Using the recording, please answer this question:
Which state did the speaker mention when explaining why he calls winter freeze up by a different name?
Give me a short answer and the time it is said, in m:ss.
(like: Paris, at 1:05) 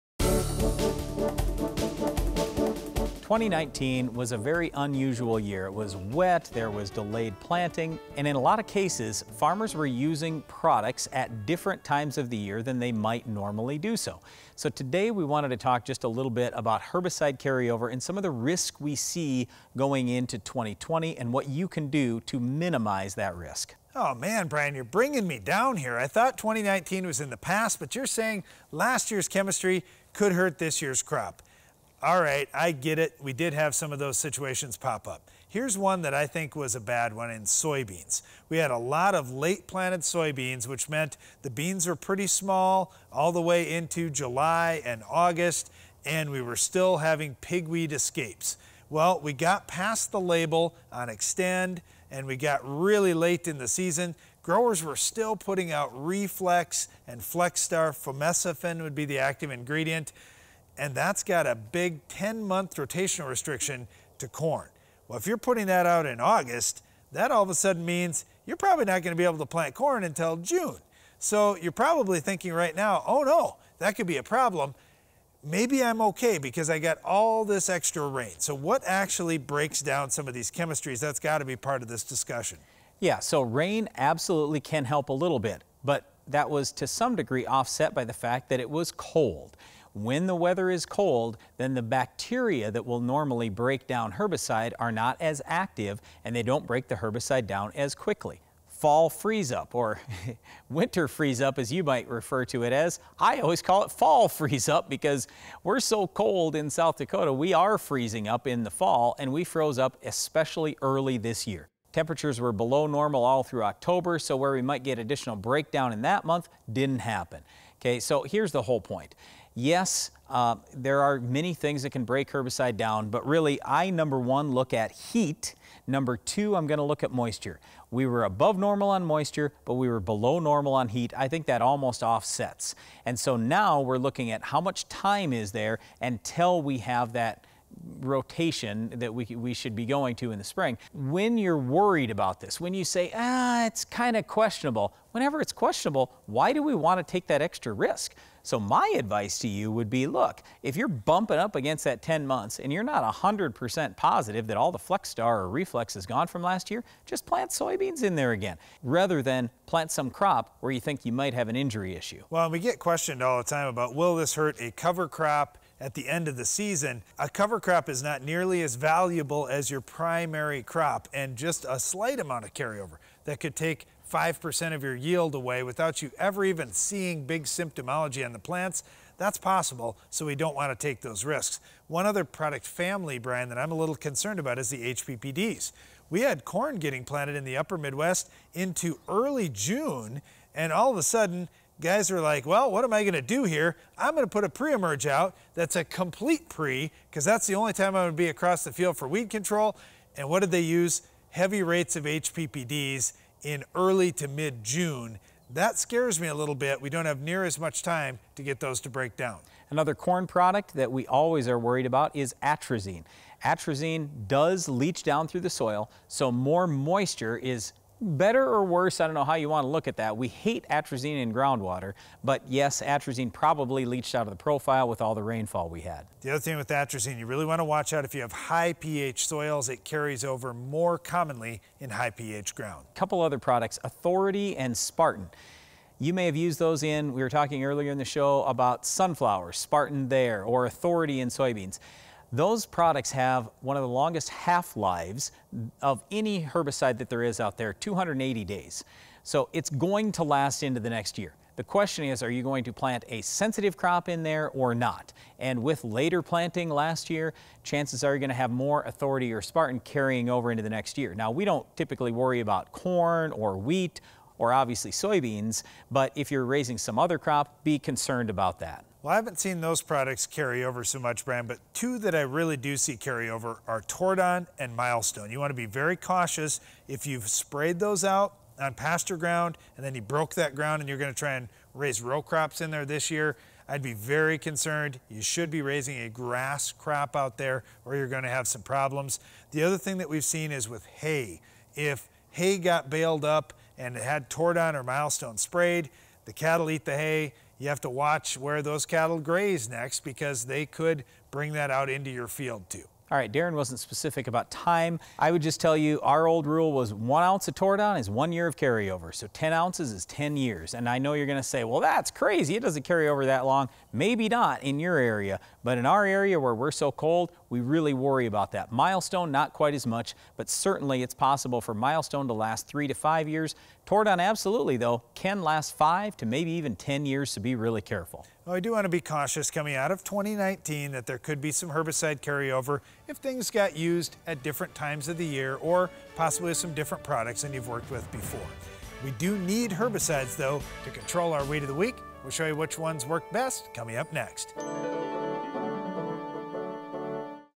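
South Dakota, at 1:46.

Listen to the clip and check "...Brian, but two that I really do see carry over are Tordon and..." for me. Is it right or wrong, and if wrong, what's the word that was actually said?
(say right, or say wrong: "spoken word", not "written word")
right.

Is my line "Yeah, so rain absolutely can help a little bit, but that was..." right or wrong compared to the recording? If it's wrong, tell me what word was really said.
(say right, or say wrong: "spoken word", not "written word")
right.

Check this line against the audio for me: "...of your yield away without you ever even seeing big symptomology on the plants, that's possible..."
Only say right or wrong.
right.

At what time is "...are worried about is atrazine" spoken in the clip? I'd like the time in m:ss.
3:31.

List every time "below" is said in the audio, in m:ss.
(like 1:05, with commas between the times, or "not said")
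1:52, 2:09.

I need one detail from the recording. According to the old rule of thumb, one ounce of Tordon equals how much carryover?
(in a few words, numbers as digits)
1 year.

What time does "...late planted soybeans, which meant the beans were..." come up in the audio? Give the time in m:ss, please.
0:39.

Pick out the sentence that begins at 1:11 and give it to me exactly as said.
So you're probably thinking right now, oh no, that could be a problem.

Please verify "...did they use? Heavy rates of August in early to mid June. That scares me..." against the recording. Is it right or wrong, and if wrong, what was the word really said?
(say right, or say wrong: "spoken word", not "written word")
wrong: "HPPDs", not "August".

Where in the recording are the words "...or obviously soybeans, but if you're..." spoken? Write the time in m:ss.
4:24.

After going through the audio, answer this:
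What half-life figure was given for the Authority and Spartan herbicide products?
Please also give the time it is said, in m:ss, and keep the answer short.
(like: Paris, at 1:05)
280 days, at 4:07.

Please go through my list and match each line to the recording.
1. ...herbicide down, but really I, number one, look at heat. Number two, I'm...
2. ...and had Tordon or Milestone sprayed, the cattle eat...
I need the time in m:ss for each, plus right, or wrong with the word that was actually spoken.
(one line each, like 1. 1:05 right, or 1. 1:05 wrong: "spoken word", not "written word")
1. 2:02 right
2. 4:53 right.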